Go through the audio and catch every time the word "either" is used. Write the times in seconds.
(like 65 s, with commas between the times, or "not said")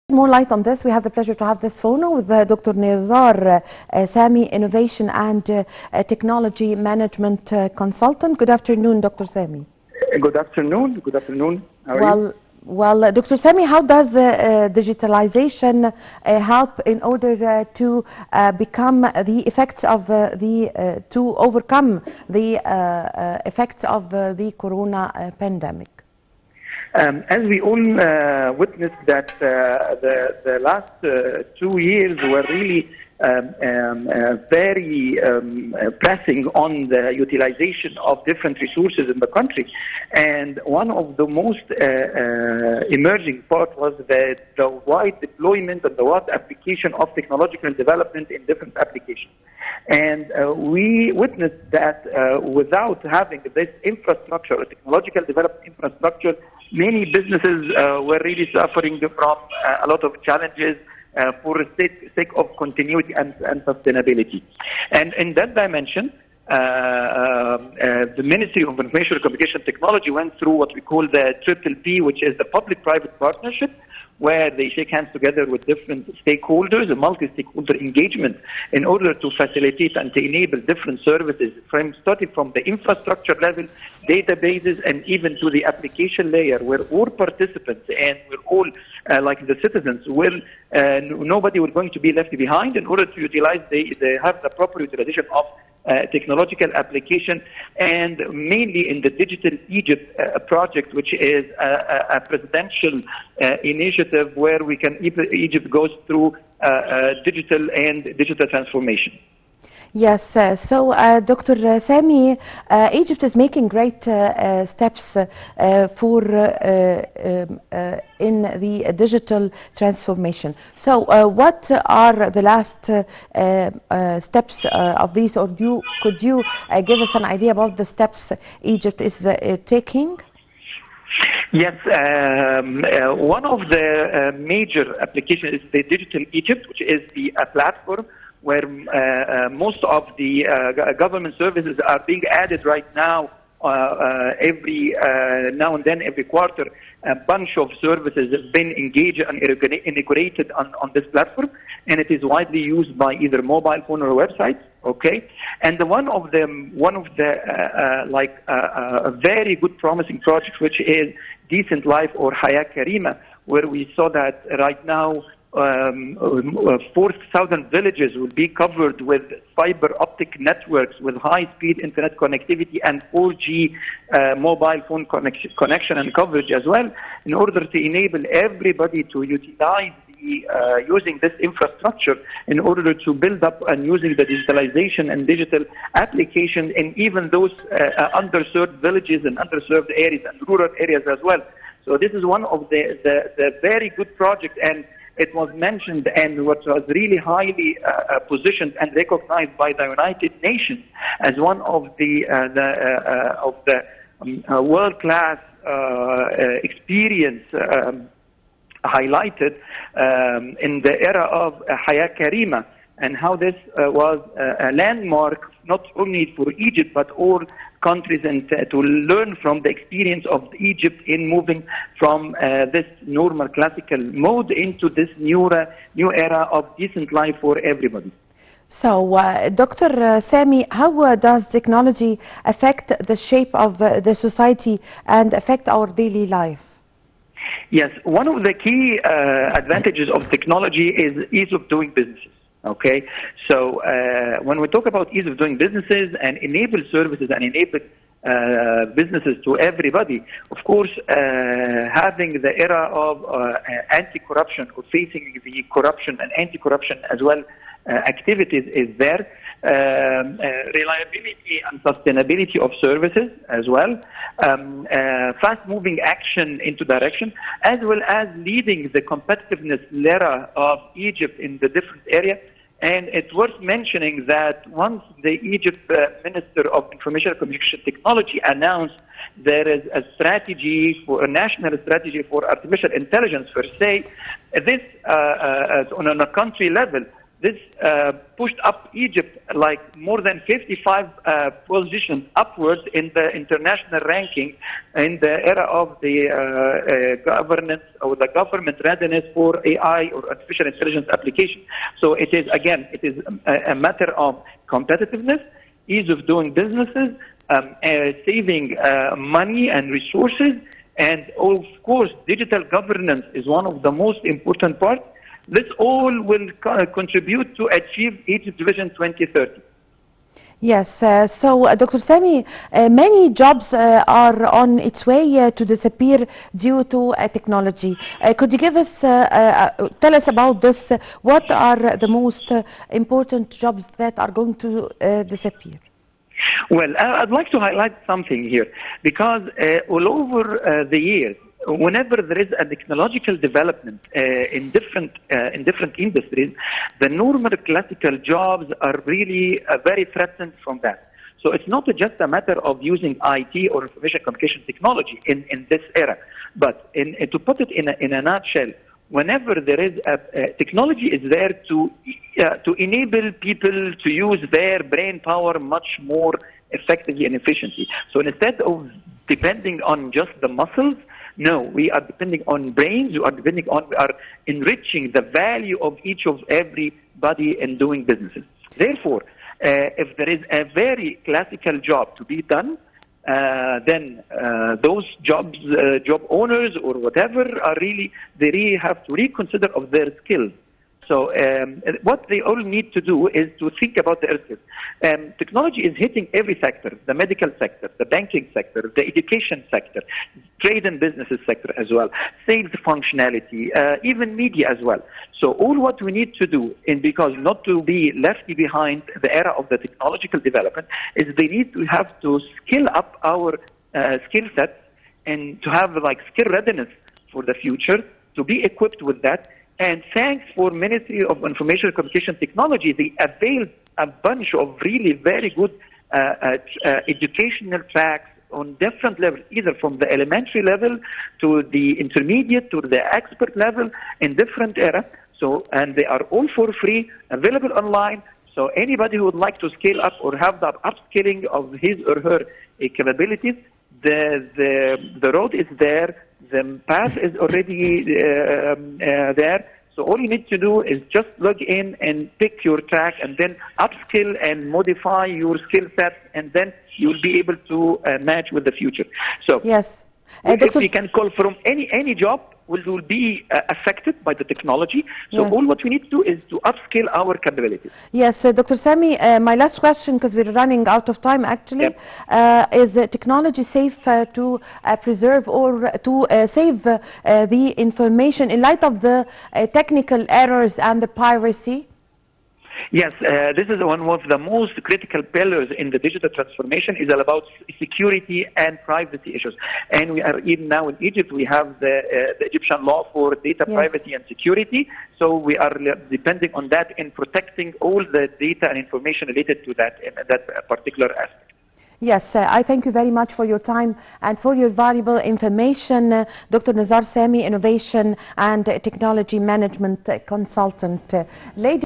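153 s, 429 s.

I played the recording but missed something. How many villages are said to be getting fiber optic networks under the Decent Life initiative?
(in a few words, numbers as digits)
4,000.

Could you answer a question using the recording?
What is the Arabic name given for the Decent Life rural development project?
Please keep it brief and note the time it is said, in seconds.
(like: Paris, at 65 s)
Hayat Karima, at 211 s.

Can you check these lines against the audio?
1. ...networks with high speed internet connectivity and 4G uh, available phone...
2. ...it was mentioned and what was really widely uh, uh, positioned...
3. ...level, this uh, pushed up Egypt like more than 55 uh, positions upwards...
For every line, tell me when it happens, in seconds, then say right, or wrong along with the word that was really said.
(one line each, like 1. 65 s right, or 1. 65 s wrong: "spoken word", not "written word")
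1. 170 s wrong: "mobile", not "available"
2. 195 s wrong: "highly", not "widely"
3. 286 s right.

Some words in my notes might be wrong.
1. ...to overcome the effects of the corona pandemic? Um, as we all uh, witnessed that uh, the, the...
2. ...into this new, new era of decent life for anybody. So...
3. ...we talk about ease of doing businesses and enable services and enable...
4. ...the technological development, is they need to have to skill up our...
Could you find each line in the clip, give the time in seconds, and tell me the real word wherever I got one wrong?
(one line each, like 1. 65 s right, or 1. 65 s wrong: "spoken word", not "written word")
1. 21 s right
2. 224 s wrong: "everybody", not "anybody"
3. 244 s right
4. 409 s right.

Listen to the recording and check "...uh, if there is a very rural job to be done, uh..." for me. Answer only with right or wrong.
wrong.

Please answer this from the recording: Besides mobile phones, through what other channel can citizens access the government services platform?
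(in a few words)
websites.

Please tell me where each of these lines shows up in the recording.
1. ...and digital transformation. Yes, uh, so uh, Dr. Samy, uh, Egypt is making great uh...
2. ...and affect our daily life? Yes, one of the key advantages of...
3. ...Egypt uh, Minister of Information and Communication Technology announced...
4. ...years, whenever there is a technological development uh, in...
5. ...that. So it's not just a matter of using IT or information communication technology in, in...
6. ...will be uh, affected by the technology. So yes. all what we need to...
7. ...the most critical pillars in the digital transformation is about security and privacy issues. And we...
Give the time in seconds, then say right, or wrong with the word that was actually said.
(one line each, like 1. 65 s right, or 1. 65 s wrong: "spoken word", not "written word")
1. 107 s right
2. 235 s right
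3. 275 s right
4. 341 s right
5. 350 s right
6. 462 s right
7. 484 s right.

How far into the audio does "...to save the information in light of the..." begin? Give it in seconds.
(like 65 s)
476 s.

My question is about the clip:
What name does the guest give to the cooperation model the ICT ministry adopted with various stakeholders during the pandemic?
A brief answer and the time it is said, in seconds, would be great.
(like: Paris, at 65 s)
Triple P, at 71 s.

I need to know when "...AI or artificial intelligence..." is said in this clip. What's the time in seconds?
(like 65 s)
299 s.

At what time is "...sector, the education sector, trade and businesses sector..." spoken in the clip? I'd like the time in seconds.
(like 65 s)
398 s.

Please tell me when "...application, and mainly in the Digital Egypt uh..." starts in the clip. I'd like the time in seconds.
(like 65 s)
96 s.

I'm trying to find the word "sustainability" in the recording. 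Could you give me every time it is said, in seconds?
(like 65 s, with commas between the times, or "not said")
63 s, 261 s.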